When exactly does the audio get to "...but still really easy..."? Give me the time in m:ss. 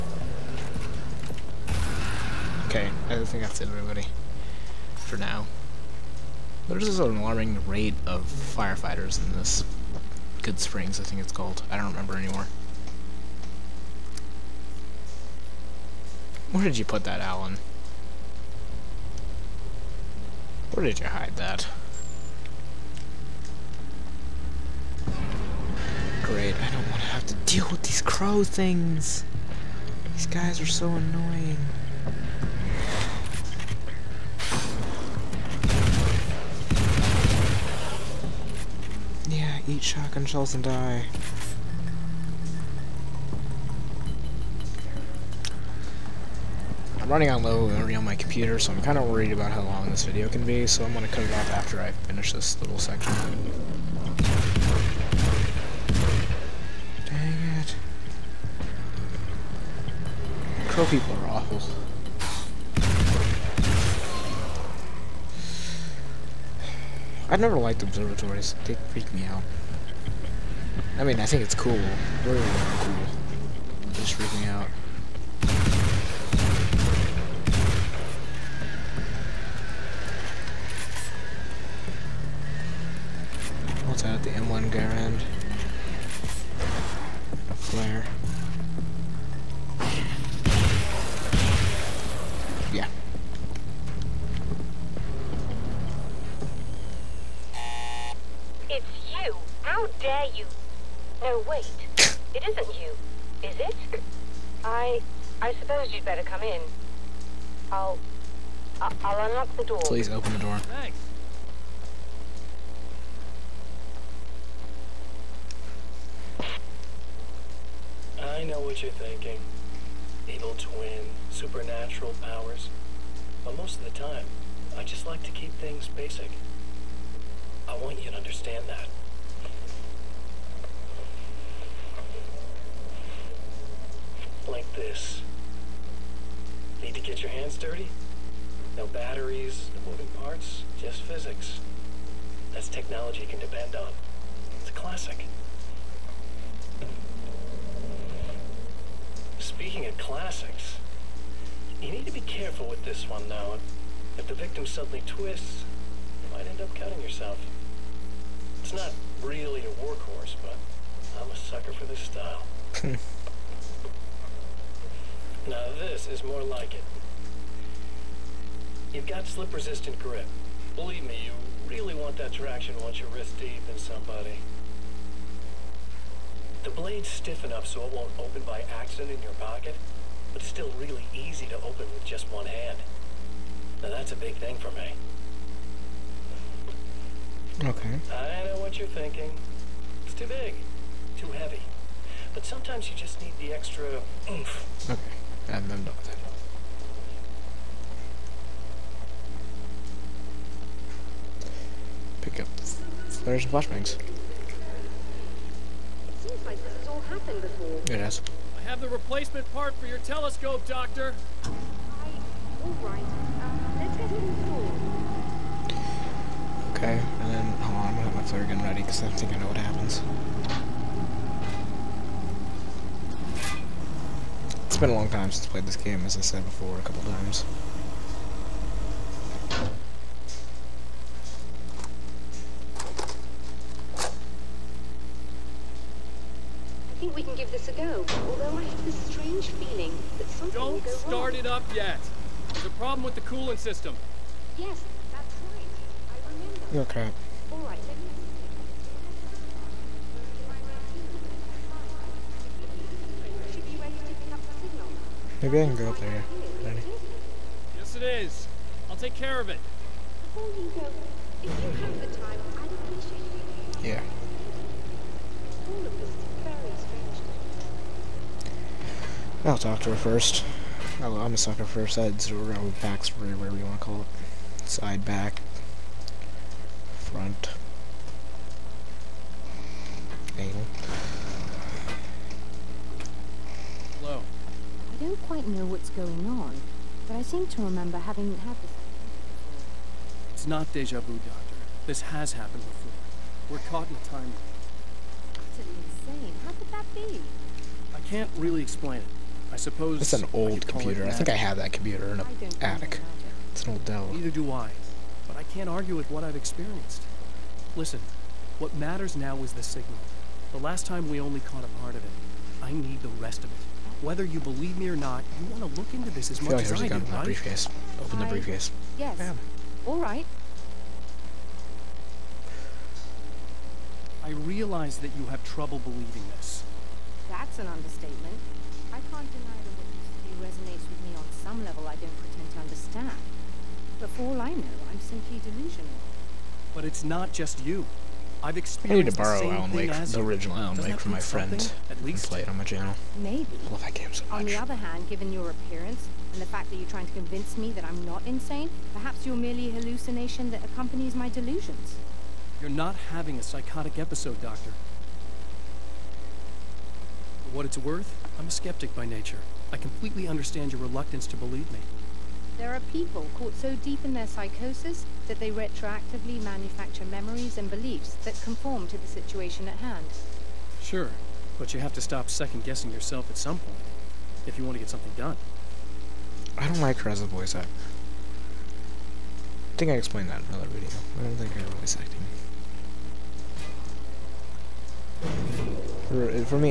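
3:00.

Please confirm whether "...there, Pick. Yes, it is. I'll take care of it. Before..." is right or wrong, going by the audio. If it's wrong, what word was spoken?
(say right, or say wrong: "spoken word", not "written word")
wrong: "Danny", not "Pick".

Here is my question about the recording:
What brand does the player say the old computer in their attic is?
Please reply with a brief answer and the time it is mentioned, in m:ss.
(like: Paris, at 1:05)
Dell, at 5:03.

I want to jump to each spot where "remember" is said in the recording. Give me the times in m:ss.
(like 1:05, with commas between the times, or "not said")
0:11, 4:06, 4:47.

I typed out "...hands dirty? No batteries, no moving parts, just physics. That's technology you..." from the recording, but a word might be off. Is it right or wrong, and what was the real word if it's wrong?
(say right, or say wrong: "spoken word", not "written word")
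right.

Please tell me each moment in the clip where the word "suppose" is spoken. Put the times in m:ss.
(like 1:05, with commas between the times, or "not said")
1:45, 4:59.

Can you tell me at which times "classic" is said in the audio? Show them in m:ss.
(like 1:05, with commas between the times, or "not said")
2:24, 2:29.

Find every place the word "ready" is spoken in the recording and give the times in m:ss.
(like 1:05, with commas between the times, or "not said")
3:38.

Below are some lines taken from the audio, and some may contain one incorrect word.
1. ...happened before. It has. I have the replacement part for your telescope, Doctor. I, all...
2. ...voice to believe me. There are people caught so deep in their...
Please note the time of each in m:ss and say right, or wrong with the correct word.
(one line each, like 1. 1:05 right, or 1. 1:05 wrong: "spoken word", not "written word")
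1. 3:27 right
2. 6:00 wrong: "reluctance", not "voice".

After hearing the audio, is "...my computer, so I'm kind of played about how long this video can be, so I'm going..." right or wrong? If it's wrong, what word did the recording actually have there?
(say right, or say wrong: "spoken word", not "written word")
wrong: "worried", not "played".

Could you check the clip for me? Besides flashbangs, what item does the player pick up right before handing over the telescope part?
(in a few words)
flares.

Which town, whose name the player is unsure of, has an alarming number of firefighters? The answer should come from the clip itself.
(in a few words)
Good Springs.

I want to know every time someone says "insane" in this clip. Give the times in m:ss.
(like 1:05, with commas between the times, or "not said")
4:56, 5:48.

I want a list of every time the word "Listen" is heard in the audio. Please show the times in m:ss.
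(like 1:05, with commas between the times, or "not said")
5:07.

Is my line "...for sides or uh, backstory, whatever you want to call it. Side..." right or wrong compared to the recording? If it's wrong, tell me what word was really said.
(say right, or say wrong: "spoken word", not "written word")
right.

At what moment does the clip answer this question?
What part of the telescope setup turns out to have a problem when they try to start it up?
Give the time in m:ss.
4:03.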